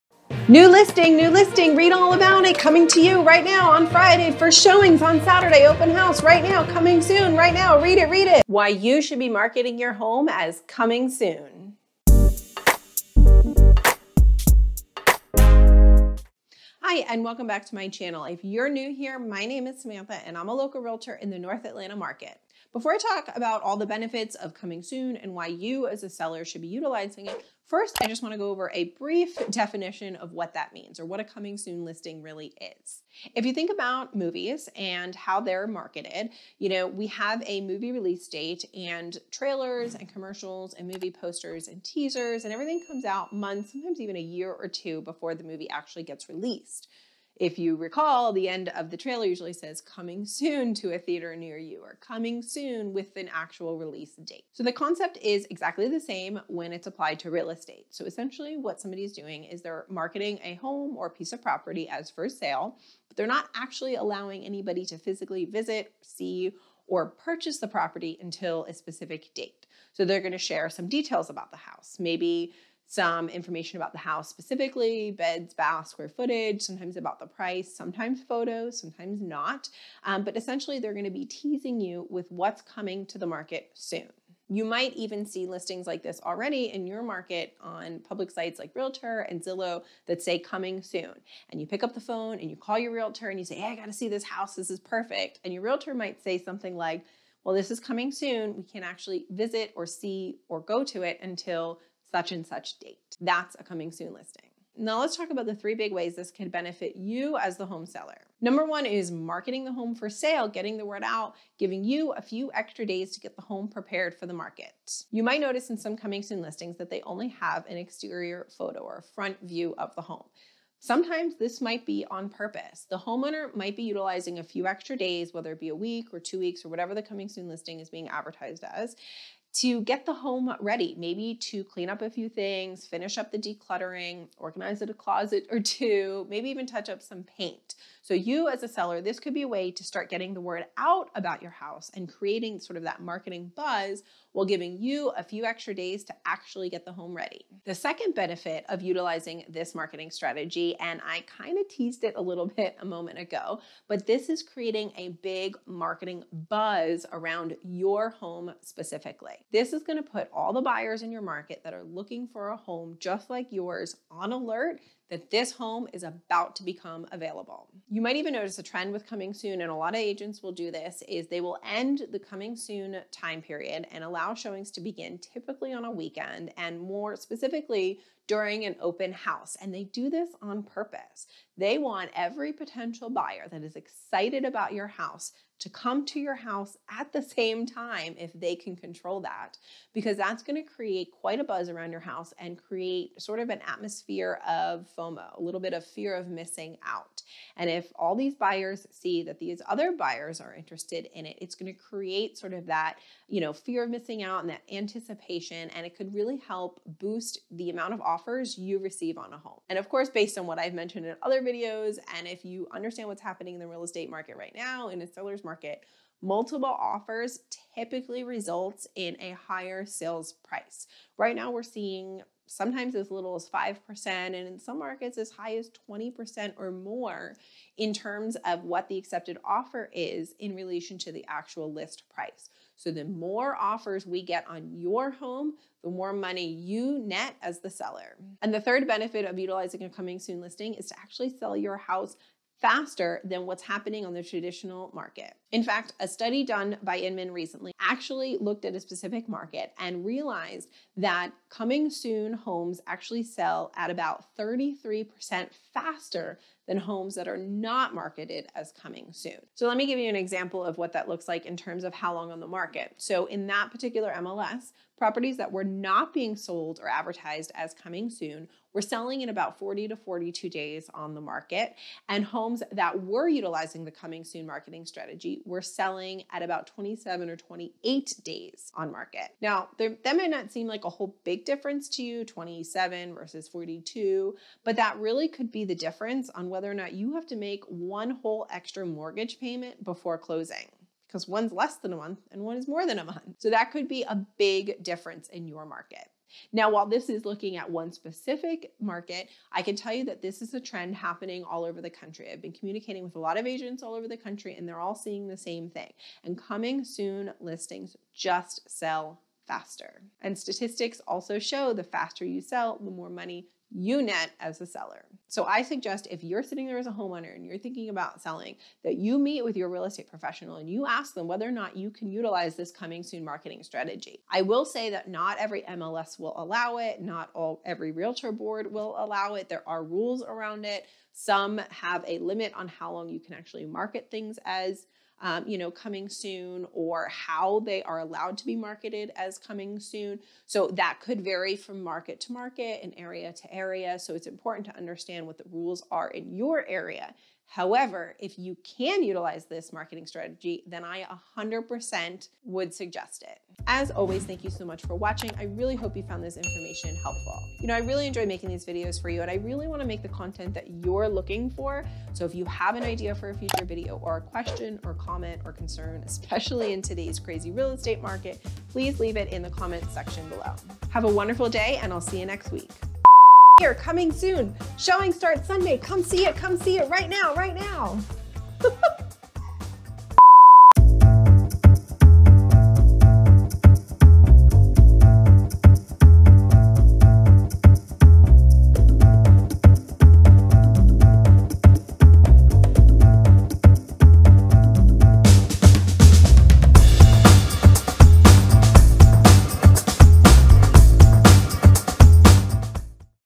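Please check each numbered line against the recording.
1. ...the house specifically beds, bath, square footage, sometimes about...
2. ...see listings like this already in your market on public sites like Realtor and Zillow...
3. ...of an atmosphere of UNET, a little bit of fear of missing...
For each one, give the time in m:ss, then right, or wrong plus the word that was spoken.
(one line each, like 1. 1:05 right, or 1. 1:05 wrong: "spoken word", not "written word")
1. 1:13 right
2. 1:25 right
3. 3:13 wrong: "FOMO", not "UNET".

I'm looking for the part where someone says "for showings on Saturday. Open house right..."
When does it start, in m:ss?
0:04.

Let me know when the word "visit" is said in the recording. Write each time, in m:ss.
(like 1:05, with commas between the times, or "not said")
1:05, 1:39.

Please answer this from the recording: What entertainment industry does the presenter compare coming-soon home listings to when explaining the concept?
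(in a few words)
Movies.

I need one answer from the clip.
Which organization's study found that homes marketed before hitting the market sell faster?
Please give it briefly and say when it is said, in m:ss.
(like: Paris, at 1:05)
Inman, at 4:06.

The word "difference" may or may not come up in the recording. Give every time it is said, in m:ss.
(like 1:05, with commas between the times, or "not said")
4:41, 4:45, 4:54.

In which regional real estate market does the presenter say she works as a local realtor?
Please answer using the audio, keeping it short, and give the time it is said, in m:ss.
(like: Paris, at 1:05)
North Atlanta, at 0:21.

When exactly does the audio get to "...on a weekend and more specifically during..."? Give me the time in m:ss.
2:55.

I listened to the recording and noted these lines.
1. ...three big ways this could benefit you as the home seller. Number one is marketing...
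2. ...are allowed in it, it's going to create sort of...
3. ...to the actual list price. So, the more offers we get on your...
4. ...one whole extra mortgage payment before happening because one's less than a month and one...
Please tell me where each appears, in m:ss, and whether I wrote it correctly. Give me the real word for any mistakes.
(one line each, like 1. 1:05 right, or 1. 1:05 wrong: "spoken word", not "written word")
1. 1:45 right
2. 3:20 wrong: "interested", not "allowed"
3. 3:50 right
4. 4:47 wrong: "closing", not "happening".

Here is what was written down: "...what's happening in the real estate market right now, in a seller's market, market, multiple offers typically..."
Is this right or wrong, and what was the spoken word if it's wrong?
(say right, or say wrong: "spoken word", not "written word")
right.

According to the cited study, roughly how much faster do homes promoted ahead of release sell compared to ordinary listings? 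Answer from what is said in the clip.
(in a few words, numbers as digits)
33%.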